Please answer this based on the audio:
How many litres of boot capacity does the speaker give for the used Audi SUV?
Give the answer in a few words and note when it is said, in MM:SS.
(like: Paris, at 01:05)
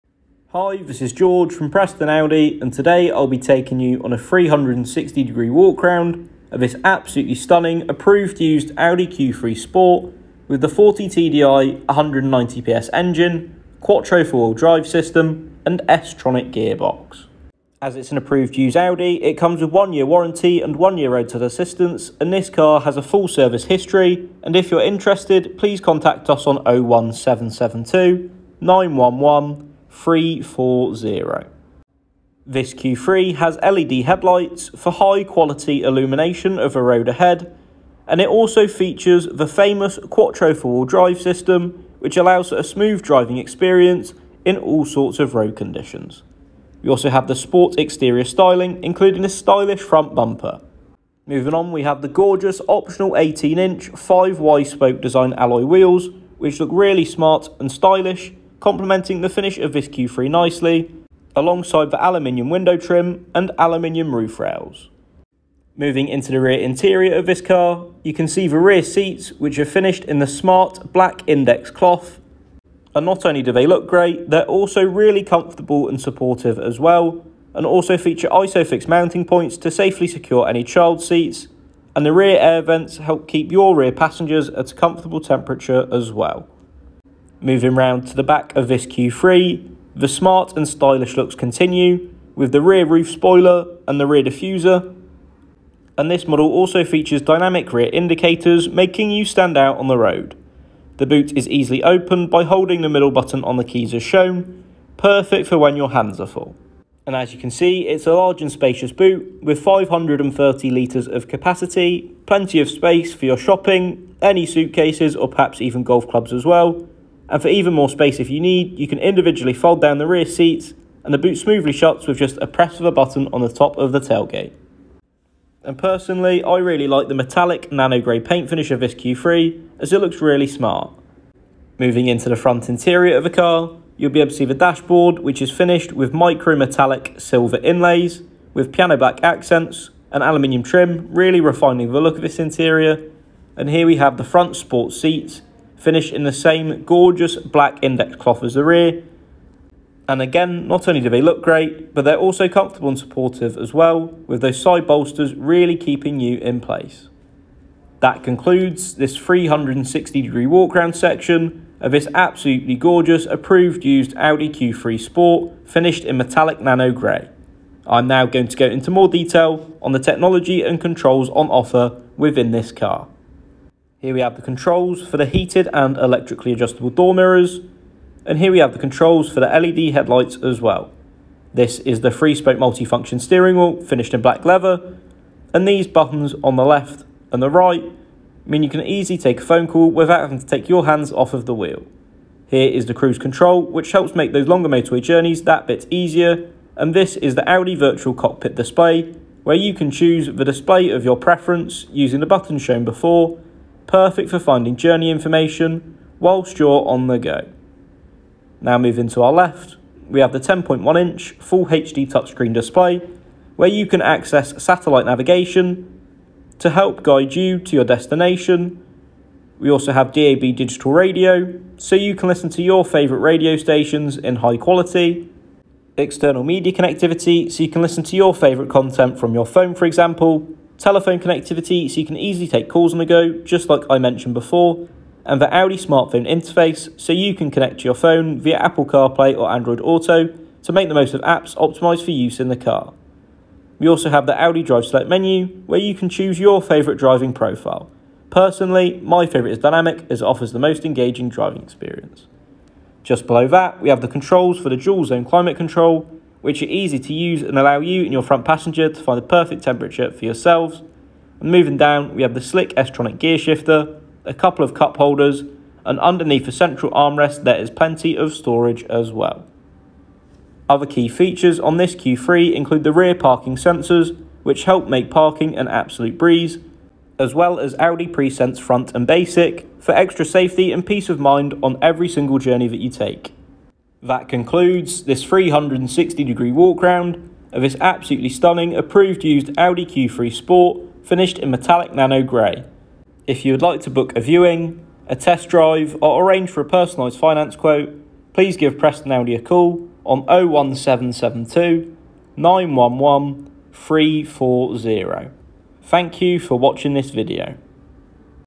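530 litres, at 01:49.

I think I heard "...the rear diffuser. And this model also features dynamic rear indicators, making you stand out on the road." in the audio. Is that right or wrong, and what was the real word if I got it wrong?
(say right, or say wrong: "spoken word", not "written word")
right.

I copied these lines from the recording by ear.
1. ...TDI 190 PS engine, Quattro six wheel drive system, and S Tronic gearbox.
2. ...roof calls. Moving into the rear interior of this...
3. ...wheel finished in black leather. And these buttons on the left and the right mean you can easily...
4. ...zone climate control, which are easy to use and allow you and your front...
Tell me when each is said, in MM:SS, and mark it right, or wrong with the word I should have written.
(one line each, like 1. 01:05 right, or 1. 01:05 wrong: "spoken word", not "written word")
1. 00:11 wrong: "four", not "six"
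2. 01:04 wrong: "rails", not "calls"
3. 03:03 right
4. 04:15 right.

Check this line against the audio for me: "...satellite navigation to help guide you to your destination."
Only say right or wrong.
right.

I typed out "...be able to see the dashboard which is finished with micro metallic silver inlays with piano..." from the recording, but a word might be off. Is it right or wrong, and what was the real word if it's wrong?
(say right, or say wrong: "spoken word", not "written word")
right.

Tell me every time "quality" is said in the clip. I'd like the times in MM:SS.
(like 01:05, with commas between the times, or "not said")
00:35, 03:44.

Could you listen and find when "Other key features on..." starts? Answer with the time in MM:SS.
04:30.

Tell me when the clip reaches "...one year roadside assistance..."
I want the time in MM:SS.
00:20.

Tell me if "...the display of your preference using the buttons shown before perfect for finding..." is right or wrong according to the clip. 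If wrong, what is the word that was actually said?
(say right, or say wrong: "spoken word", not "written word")
right.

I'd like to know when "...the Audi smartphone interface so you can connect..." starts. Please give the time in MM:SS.
03:55.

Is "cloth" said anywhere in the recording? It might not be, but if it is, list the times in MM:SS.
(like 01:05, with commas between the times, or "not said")
01:11, 02:28.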